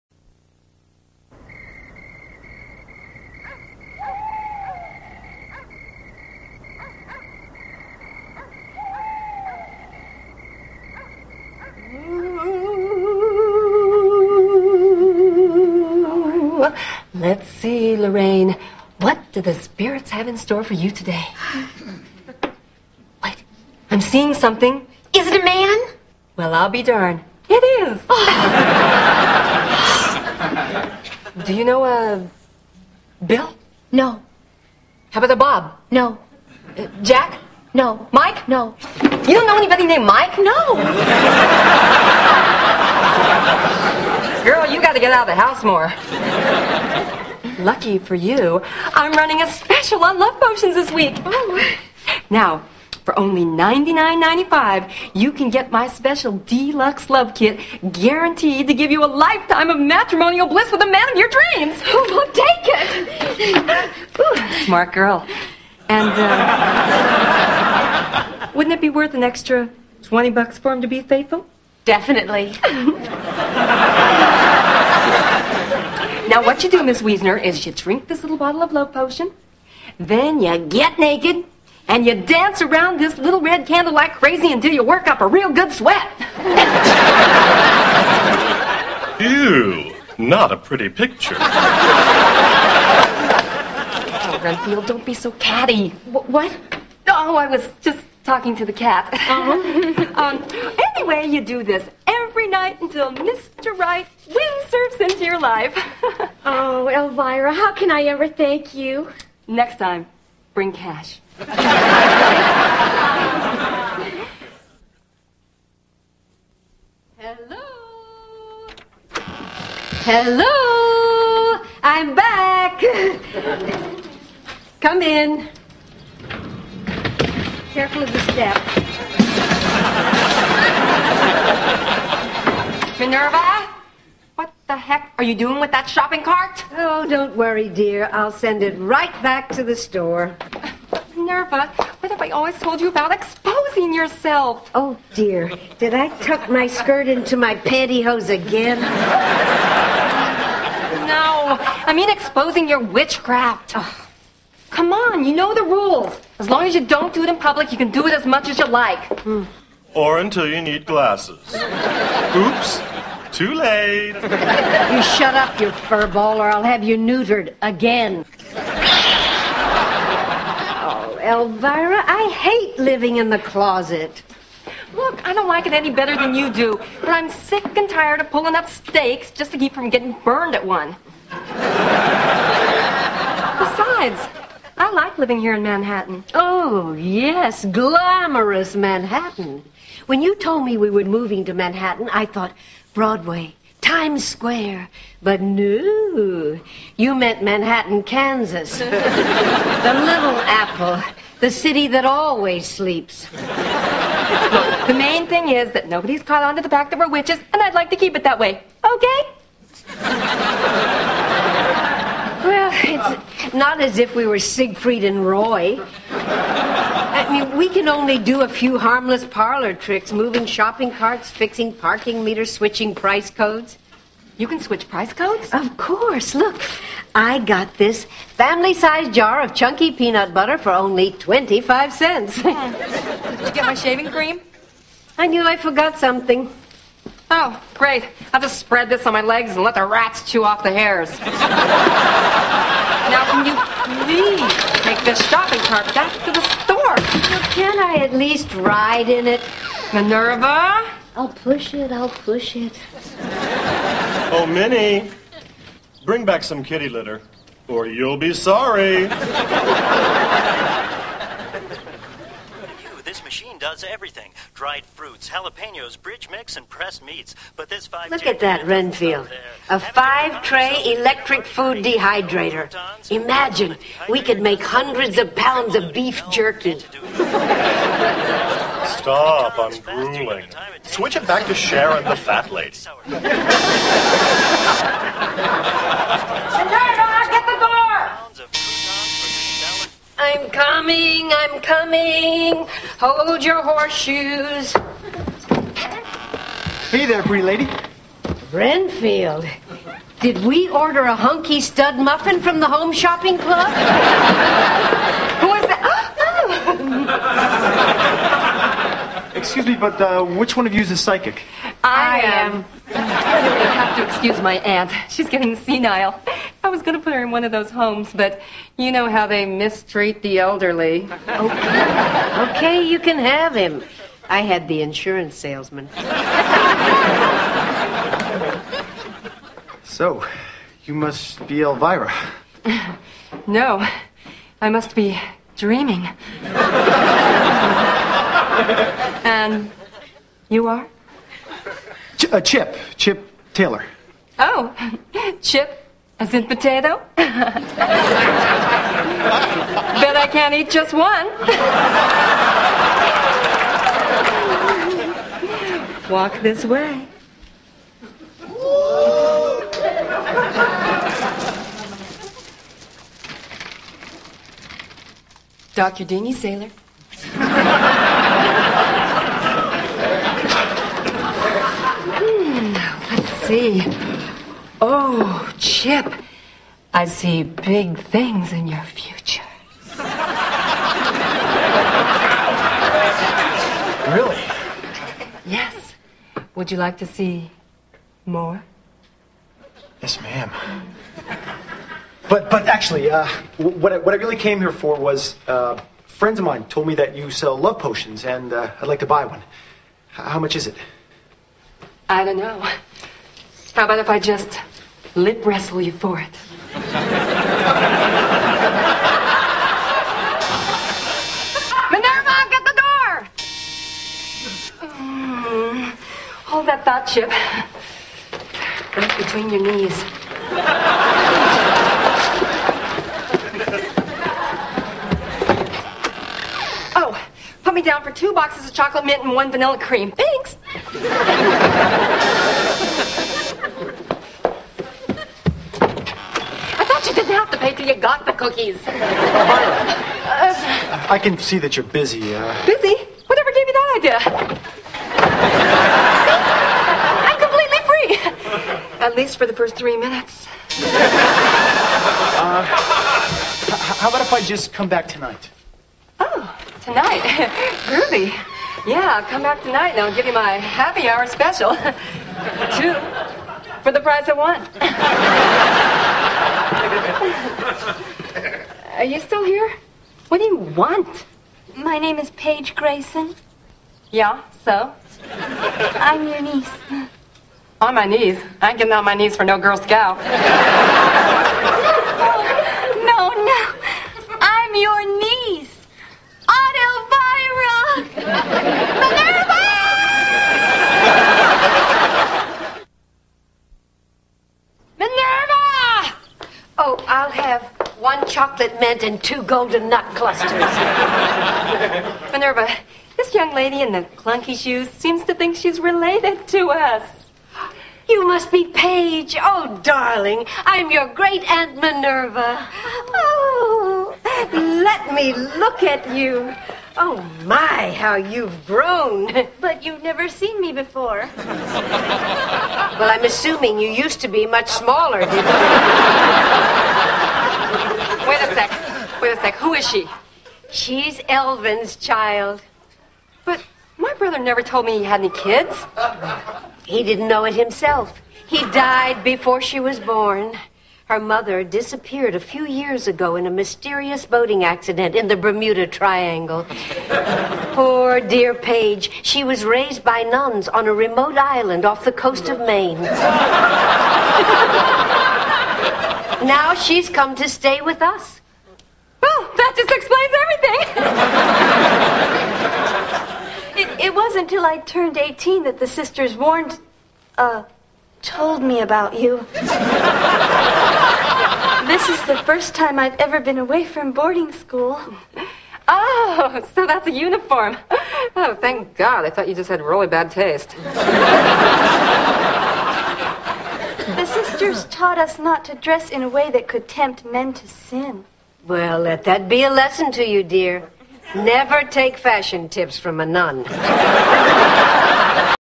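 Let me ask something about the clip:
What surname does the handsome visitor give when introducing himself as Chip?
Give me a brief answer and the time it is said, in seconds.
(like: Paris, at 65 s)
Taylor, at 343 s.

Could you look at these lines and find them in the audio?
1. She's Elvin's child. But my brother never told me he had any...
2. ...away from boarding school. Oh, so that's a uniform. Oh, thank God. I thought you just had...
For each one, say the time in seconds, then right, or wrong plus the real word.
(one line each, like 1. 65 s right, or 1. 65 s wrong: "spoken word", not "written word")
1. 530 s right
2. 573 s right.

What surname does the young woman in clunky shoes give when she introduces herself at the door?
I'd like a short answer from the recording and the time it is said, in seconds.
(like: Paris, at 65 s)
Grayson, at 472 s.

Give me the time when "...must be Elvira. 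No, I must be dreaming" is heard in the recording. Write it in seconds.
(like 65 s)
330 s.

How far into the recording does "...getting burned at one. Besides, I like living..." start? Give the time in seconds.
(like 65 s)
179 s.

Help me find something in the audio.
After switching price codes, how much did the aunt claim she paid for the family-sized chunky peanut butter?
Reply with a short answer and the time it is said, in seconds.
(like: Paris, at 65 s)
25 cents, at 231 s.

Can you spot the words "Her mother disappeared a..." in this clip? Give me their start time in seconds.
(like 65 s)
541 s.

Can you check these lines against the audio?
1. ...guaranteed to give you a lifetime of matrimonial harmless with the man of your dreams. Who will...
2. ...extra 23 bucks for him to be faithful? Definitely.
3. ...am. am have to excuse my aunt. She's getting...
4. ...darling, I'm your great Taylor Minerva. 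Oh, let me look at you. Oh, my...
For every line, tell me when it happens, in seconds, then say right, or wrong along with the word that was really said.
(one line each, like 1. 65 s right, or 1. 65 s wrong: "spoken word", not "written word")
1. 57 s wrong: "bliss", not "harmless"
2. 69 s wrong: "20", not "23"
3. 312 s right
4. 509 s wrong: "Aunt", not "Taylor".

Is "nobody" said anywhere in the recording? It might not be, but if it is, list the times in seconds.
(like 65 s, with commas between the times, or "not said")
205 s.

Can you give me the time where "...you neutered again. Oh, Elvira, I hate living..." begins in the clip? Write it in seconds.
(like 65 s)
166 s.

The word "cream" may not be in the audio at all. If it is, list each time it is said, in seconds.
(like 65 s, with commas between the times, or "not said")
234 s, 429 s.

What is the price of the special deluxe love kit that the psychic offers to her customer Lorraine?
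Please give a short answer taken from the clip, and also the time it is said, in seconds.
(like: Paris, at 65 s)
$99.95, at 53 s.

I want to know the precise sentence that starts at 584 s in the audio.
the sisters taught us not to dress in a way that could tempt men to sin.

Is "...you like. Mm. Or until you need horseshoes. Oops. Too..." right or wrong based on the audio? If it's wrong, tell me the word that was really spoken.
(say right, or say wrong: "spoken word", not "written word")
wrong: "glasses", not "horseshoes".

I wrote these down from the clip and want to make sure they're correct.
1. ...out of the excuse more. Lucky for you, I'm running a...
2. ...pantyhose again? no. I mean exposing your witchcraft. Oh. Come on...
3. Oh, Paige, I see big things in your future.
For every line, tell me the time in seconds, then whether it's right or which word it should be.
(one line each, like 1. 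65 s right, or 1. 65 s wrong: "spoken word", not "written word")
1. 45 s wrong: "house", not "excuse"
2. 147 s right
3. 374 s wrong: "Chip", not "Paige".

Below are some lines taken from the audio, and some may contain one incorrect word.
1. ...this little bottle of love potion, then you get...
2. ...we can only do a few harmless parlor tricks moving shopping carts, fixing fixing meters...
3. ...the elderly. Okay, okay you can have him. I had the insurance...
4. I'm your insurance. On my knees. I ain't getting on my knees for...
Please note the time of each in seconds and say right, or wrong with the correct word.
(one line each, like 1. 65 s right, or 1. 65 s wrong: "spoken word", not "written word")
1. 78 s right
2. 217 s wrong: "parking", not "fixing"
3. 320 s right
4. 475 s wrong: "niece", not "insurance".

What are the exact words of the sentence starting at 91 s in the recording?
Oh, Renfield, don't be so catty.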